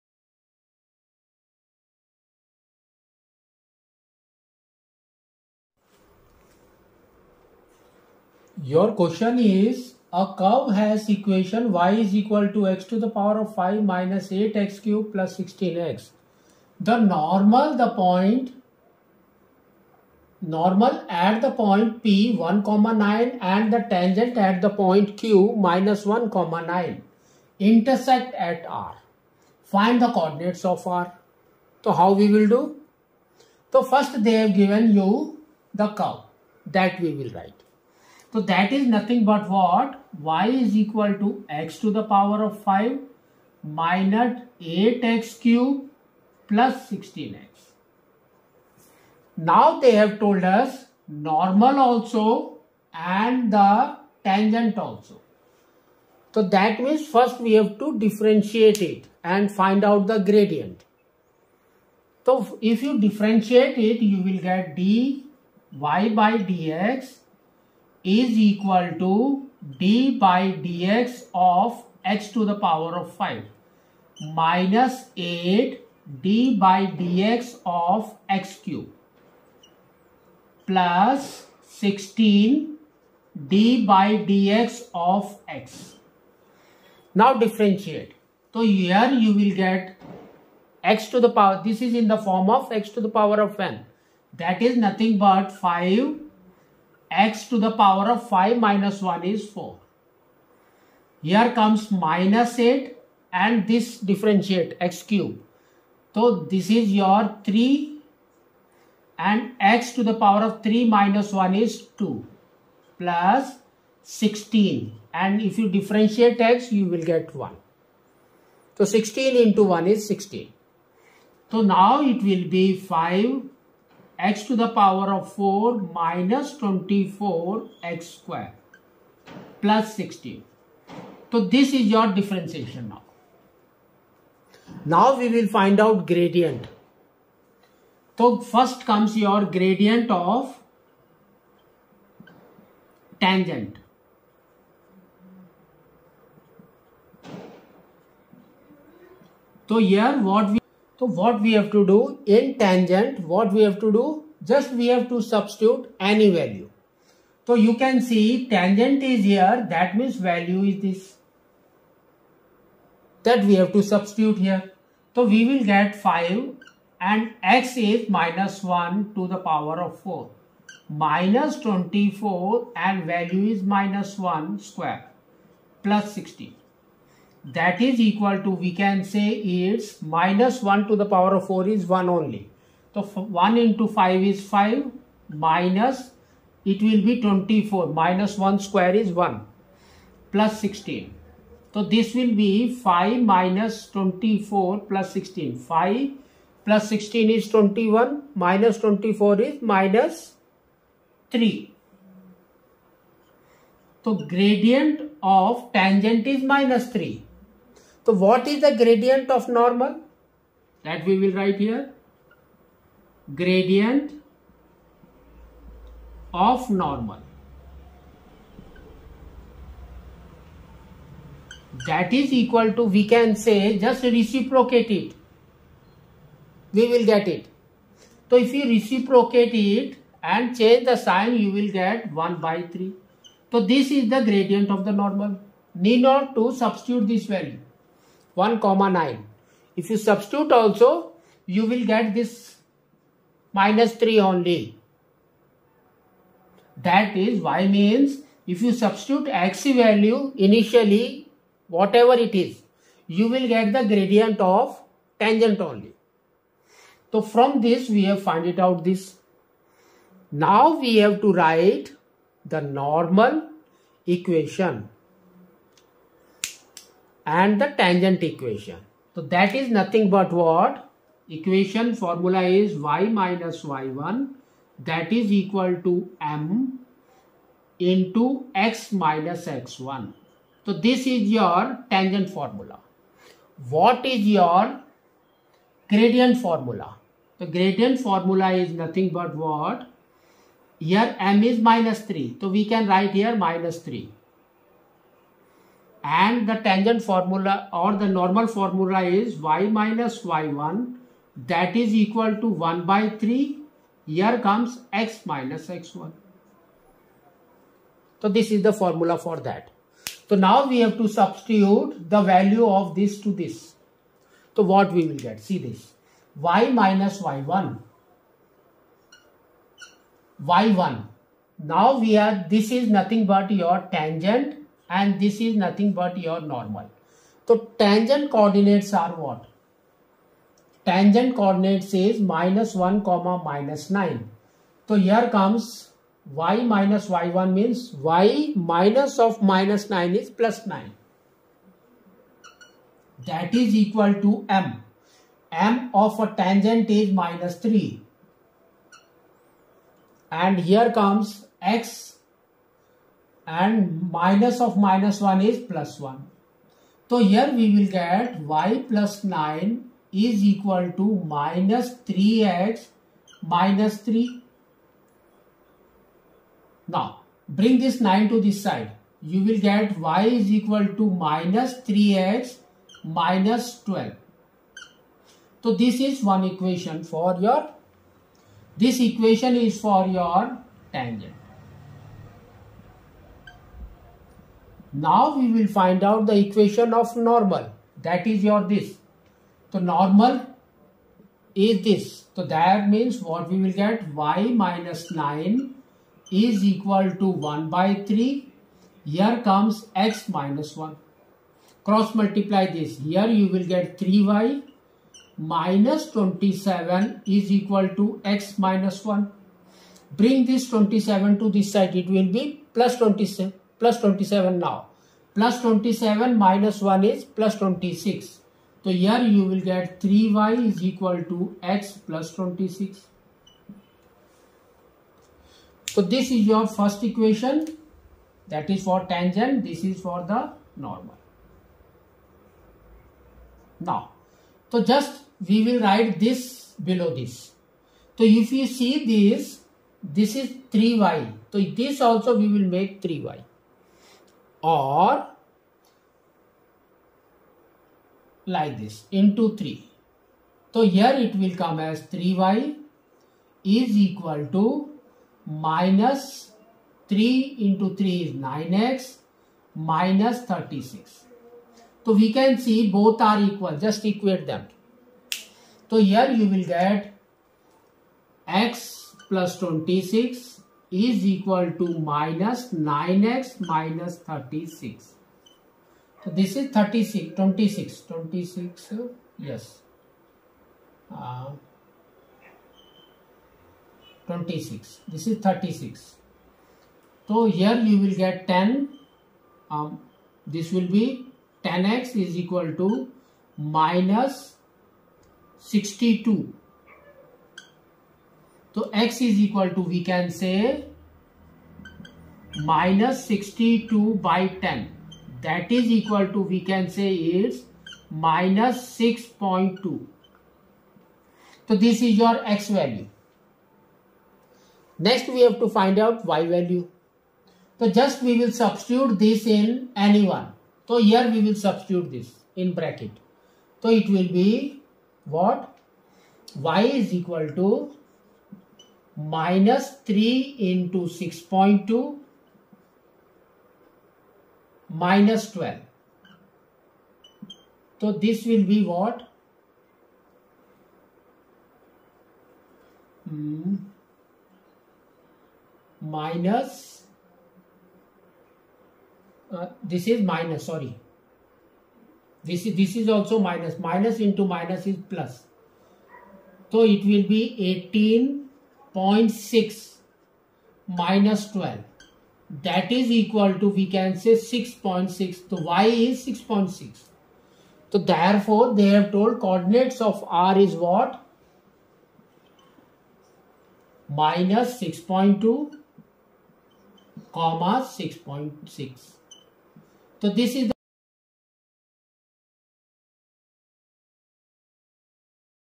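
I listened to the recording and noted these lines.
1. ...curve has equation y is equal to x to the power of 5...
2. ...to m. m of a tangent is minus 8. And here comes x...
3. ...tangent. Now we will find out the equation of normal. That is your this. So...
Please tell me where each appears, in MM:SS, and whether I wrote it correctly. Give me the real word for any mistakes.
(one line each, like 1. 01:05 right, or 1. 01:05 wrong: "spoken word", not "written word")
1. 00:10 right
2. 05:44 wrong: "3", not "8"
3. 06:20 right.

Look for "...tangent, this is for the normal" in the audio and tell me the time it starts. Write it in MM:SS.
07:09.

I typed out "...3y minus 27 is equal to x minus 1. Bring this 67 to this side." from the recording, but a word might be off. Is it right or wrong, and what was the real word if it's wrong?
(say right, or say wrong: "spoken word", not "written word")
wrong: "27", not "67".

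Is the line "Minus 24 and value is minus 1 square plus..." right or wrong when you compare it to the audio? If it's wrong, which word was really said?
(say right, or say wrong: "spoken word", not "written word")
right.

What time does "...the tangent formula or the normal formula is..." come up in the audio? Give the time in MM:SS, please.
04:56.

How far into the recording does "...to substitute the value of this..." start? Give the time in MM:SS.
05:10.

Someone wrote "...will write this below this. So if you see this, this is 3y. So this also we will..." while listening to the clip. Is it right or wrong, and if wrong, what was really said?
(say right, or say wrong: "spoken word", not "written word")
right.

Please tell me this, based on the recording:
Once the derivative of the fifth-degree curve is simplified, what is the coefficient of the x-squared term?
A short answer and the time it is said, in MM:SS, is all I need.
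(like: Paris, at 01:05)
-24, at 02:05.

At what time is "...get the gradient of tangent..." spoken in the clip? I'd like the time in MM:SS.
04:13.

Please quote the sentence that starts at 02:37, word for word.
So you can see tangent is here, that means value is this.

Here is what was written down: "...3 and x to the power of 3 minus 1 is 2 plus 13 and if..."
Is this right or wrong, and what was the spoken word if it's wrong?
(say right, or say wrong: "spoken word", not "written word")
wrong: "16", not "13".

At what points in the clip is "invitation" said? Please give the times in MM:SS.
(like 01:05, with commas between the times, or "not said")
not said.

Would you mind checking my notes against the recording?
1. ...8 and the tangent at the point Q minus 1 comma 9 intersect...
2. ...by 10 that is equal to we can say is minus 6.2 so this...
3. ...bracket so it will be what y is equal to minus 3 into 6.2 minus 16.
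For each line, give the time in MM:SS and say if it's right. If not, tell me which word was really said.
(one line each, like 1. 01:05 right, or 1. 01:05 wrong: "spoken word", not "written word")
1. 00:22 wrong: "9", not "8"
2. 08:24 right
3. 08:42 wrong: "12", not "16".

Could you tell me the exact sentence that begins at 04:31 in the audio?
Equation formula is y minus y1 that is equal to m into x minus x1.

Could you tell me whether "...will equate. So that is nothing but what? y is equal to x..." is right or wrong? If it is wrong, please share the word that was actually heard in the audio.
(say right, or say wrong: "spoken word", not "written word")
wrong: "write", not "equate".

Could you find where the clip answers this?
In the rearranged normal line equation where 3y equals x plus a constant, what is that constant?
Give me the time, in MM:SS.
06:59.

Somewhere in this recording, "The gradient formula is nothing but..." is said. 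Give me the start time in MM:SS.
04:47.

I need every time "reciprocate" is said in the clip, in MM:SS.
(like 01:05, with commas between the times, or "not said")
03:44, 03:48.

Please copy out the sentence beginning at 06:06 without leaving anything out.
Now bring this 9 to this side.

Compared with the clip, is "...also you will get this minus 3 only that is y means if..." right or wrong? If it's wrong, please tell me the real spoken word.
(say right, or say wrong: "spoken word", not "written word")
right.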